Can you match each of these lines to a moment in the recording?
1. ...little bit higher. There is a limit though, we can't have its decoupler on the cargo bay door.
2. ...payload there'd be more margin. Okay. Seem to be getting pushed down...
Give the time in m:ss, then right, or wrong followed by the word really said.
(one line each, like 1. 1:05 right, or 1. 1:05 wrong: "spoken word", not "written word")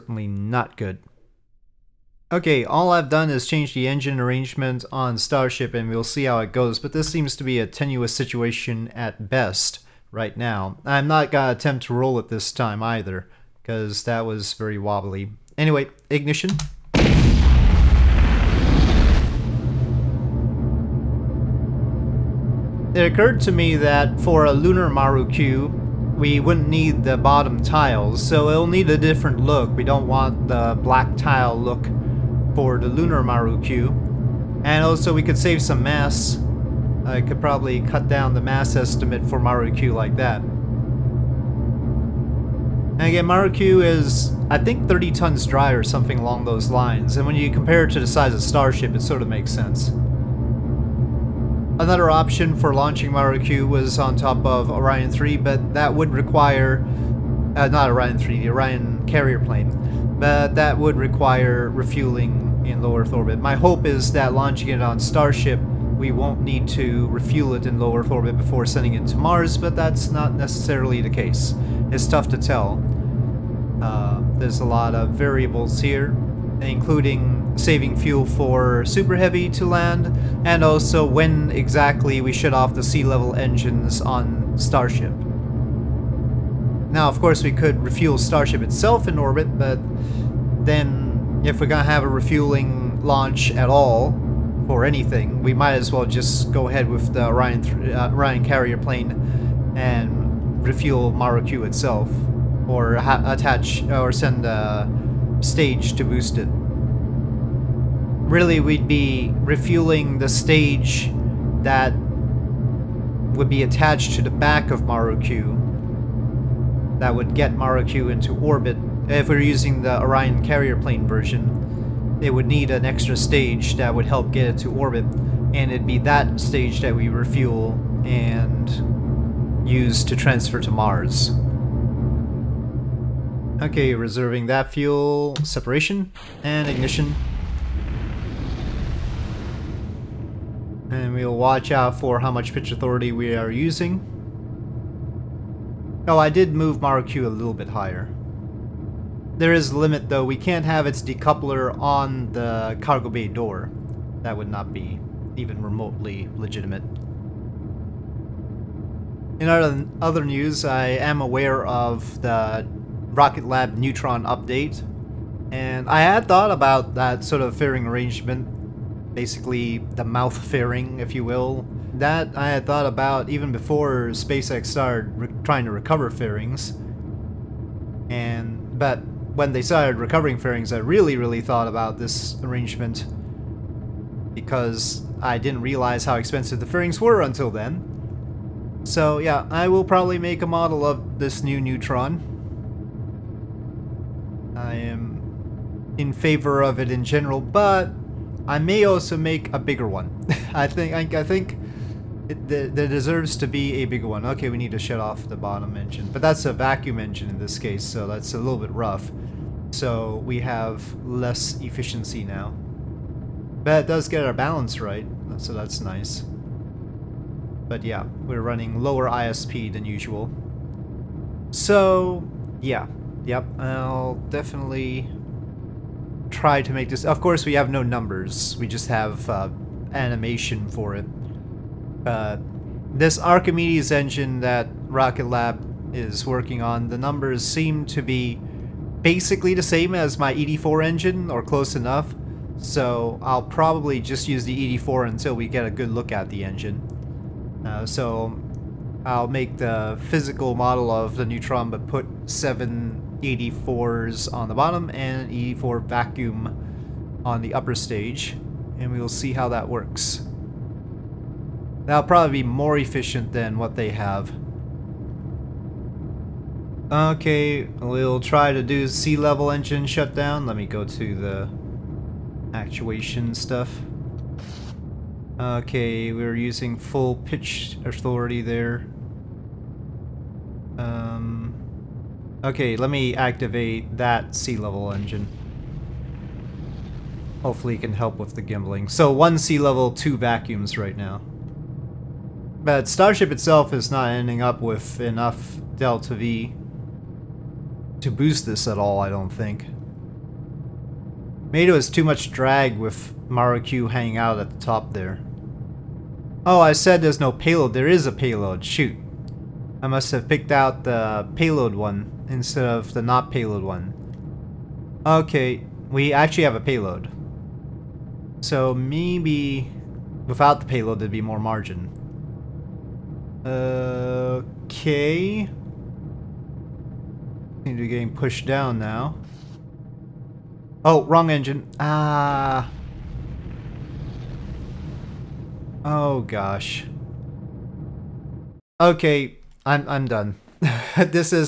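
1. 2:27 right
2. 5:20 right.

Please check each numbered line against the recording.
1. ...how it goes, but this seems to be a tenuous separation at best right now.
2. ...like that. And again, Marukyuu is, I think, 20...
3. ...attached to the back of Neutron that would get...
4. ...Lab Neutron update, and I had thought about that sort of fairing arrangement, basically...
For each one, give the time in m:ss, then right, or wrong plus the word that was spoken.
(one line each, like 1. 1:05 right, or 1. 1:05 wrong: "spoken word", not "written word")
1. 0:06 wrong: "situation", not "separation"
2. 0:39 wrong: "30", not "20"
3. 1:53 wrong: "Marukyuu", not "Neutron"
4. 2:43 right.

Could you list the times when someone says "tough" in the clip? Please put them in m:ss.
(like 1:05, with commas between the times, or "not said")
1:12.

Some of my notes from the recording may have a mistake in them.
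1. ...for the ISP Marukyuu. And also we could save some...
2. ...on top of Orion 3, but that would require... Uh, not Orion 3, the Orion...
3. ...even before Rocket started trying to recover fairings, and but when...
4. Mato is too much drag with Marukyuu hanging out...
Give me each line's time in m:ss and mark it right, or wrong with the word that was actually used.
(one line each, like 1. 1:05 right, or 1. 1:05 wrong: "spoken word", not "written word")
1. 0:32 wrong: "Lunar", not "ISP"
2. 0:53 right
3. 2:53 wrong: "SpaceX", not "Rocket"
4. 5:01 right.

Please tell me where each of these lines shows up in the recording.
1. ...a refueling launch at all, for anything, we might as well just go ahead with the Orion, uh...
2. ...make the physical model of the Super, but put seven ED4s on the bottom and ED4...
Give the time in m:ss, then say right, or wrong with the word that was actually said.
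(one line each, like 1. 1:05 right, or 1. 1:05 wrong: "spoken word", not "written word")
1. 1:32 right
2. 4:09 wrong: "Neutron", not "Super".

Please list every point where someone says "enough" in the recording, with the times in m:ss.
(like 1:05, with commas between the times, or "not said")
4:01, 4:54.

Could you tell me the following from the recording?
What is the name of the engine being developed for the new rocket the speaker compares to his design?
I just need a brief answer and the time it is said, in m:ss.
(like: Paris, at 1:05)
Archimedes, at 3:53.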